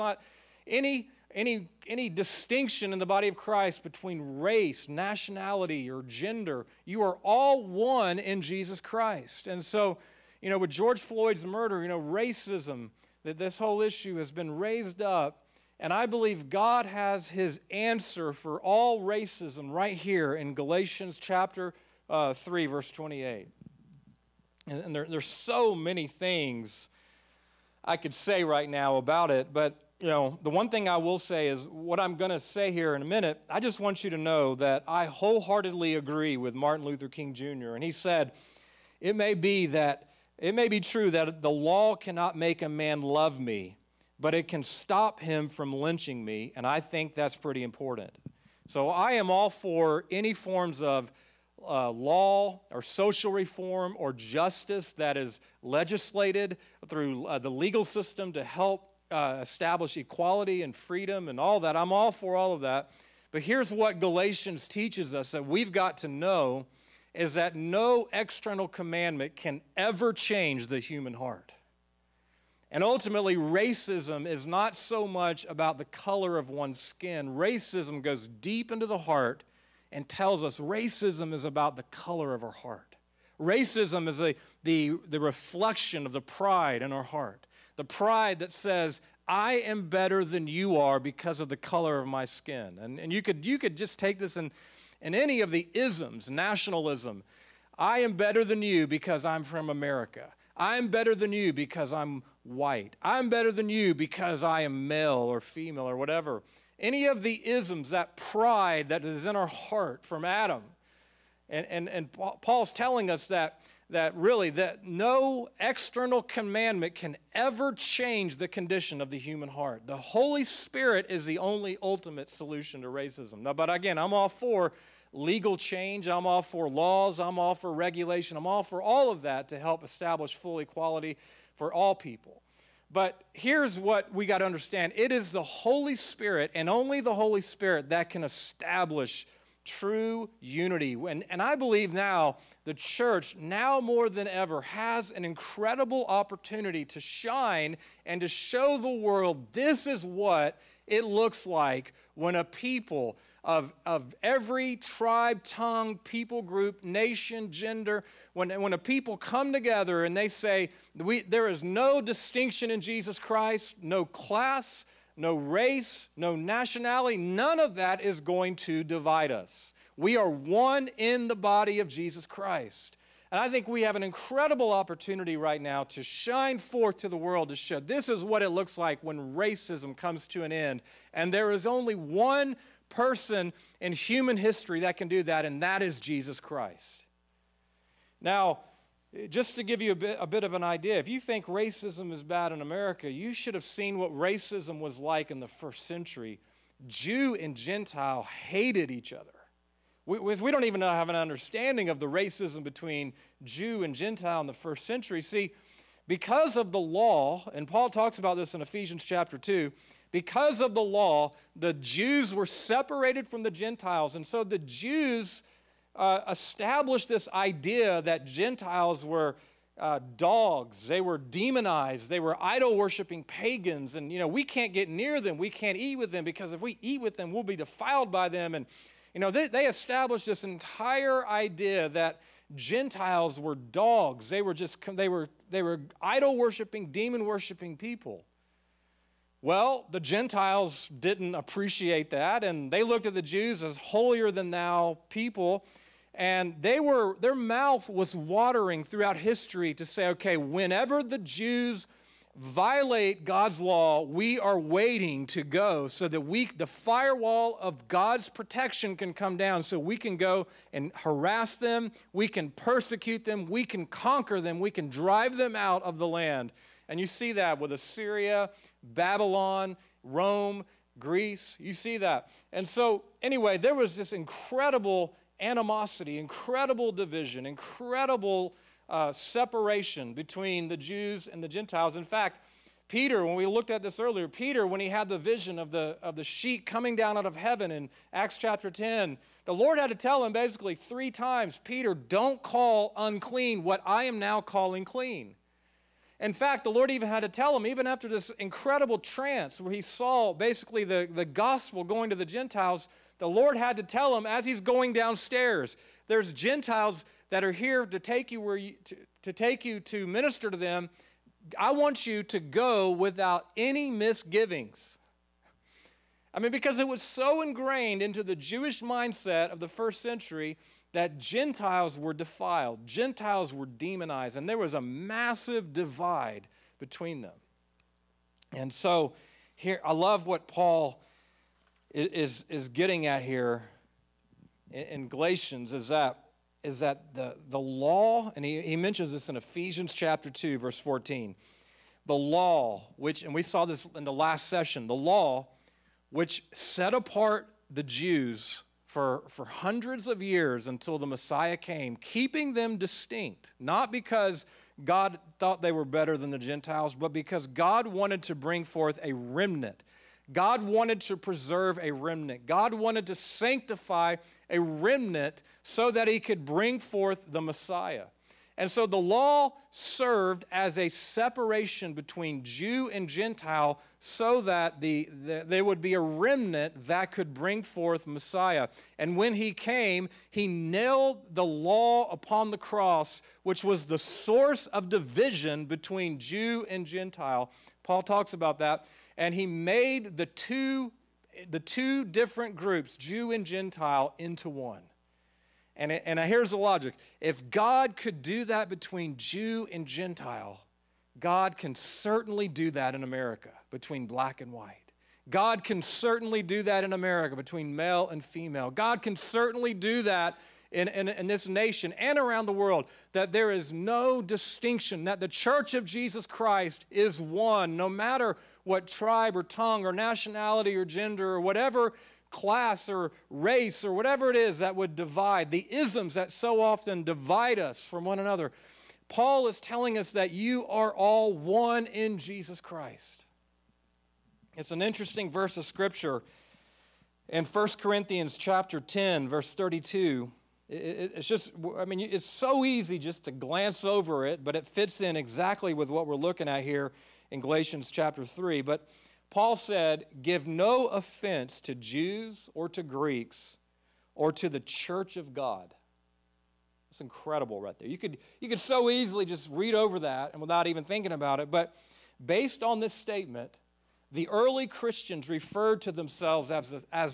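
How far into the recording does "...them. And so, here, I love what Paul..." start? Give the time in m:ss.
5:27.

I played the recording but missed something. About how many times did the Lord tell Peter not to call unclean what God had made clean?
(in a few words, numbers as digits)
3.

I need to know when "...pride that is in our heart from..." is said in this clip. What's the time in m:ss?
1:48.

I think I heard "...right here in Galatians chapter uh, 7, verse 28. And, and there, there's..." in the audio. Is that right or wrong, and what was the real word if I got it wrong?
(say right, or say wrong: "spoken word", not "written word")
wrong: "3", not "7".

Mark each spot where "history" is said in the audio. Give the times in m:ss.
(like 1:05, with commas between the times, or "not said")
3:04, 4:09.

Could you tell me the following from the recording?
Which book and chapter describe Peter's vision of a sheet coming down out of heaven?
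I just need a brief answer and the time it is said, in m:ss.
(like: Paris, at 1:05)
Acts 10, at 4:48.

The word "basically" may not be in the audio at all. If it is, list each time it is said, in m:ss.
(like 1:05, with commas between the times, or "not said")
4:50, 5:00.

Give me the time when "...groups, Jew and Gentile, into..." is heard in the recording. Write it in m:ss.
6:32.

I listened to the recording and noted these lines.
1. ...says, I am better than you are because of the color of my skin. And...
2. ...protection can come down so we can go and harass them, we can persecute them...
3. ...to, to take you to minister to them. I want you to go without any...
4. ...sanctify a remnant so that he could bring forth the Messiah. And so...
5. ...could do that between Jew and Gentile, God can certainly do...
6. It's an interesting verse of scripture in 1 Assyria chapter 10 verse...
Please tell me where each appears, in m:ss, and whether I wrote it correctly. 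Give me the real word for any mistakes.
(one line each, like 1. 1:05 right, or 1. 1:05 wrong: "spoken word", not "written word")
1. 1:28 right
2. 4:18 right
3. 5:08 right
4. 6:03 right
5. 6:37 right
6. 7:14 wrong: "Corinthians", not "Assyria".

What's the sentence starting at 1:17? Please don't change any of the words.
Racism goes deep into the heart and tells us racism is about the color of our heart.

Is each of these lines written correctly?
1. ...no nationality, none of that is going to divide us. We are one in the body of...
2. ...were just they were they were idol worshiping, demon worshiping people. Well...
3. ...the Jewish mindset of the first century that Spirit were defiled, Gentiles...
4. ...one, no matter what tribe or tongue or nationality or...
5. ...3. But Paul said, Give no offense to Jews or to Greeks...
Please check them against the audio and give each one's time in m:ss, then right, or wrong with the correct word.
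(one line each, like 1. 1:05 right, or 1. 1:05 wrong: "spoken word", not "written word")
1. 2:46 right
2. 3:54 right
3. 5:18 wrong: "Gentiles", not "Spirit"
4. 6:57 right
5. 7:28 right.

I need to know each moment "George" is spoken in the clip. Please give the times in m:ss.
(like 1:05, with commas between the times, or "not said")
0:10.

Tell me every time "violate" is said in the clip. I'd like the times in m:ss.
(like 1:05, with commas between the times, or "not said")
4:12.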